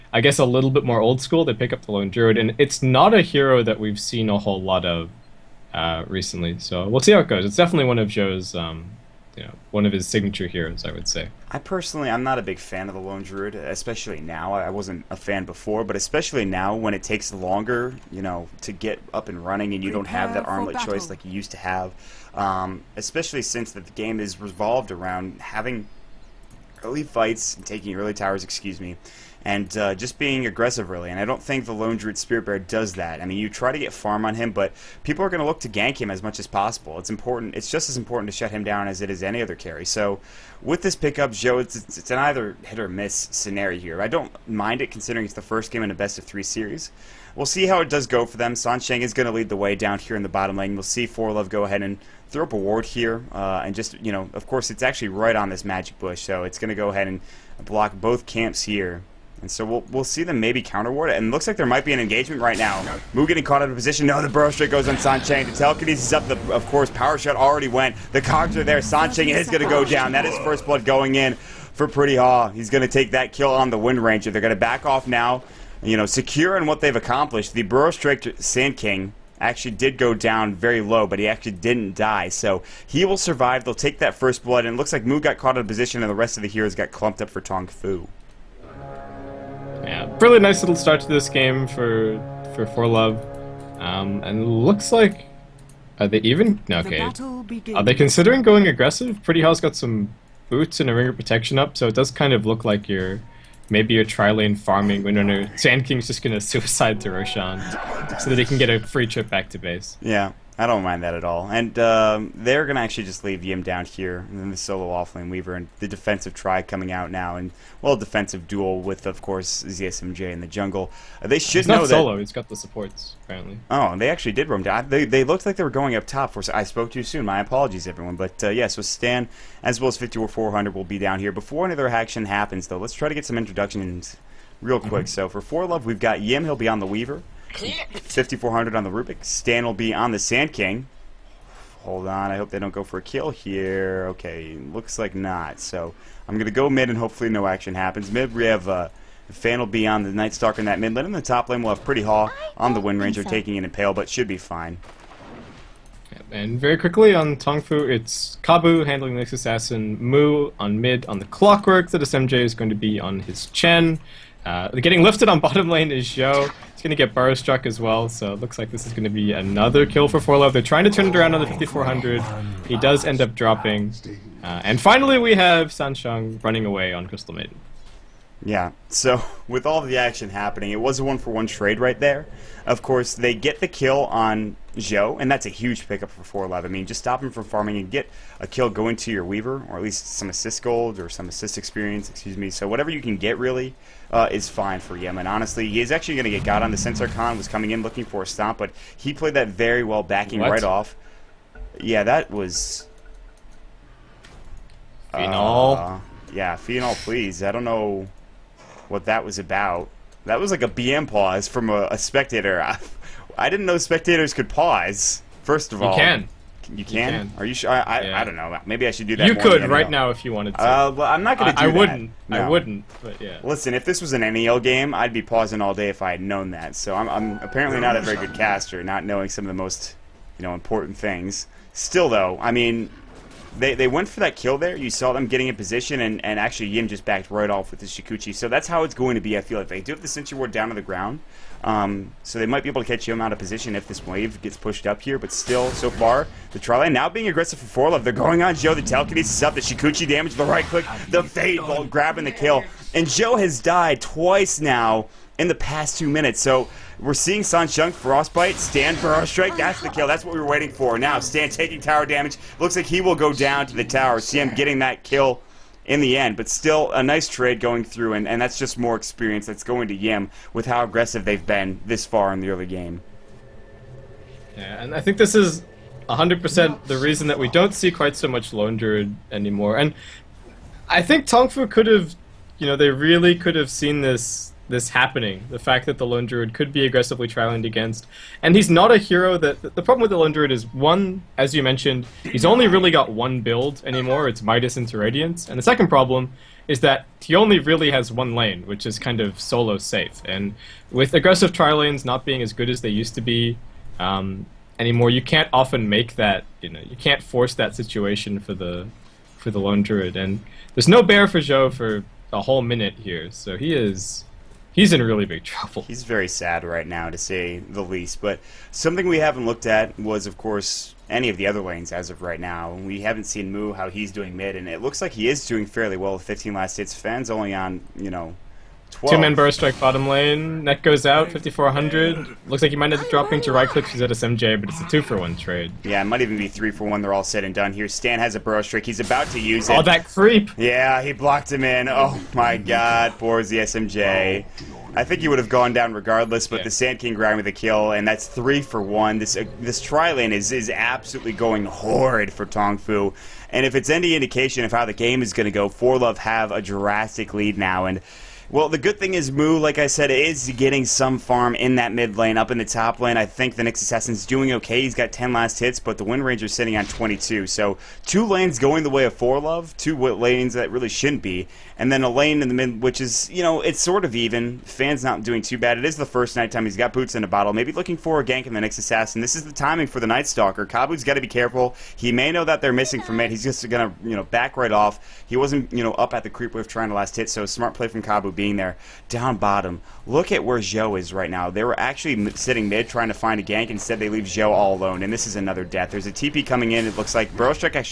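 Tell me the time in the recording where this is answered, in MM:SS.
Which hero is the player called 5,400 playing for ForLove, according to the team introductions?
02:18.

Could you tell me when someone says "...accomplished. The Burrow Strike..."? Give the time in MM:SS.
01:16.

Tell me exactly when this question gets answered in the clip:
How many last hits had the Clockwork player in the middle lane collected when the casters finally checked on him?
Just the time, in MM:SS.
05:26.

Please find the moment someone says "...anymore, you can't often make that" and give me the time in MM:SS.
05:04.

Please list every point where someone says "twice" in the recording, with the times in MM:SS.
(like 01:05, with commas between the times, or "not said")
04:13.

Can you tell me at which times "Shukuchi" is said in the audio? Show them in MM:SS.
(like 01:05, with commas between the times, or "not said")
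03:57, 04:09.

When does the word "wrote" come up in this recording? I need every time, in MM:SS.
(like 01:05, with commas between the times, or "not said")
not said.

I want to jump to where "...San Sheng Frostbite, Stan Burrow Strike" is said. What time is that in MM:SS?
04:17.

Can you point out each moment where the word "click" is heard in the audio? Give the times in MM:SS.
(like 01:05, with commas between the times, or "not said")
04:10, 05:33.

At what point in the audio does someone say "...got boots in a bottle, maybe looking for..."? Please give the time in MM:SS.
06:16.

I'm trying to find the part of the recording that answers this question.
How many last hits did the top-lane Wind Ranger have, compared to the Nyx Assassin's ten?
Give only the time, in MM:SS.
06:06.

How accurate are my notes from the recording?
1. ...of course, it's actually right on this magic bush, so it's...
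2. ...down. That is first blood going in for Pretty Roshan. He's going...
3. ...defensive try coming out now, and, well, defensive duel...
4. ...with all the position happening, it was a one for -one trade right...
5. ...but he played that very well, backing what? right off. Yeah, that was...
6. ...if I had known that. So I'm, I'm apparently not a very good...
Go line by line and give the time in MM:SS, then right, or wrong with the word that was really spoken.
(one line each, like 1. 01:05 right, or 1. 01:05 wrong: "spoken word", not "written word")
1. 00:54 right
2. 01:09 wrong: "Haw", not "Roshan"
3. 01:55 right
4. 02:59 wrong: "action", not "position"
5. 03:18 right
6. 03:45 right.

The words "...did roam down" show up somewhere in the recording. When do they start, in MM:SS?
02:04.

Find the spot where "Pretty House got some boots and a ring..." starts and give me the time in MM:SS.
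01:39.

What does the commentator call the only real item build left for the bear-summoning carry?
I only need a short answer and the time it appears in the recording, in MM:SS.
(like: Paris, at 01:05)
Midas into Radiance, at 04:54.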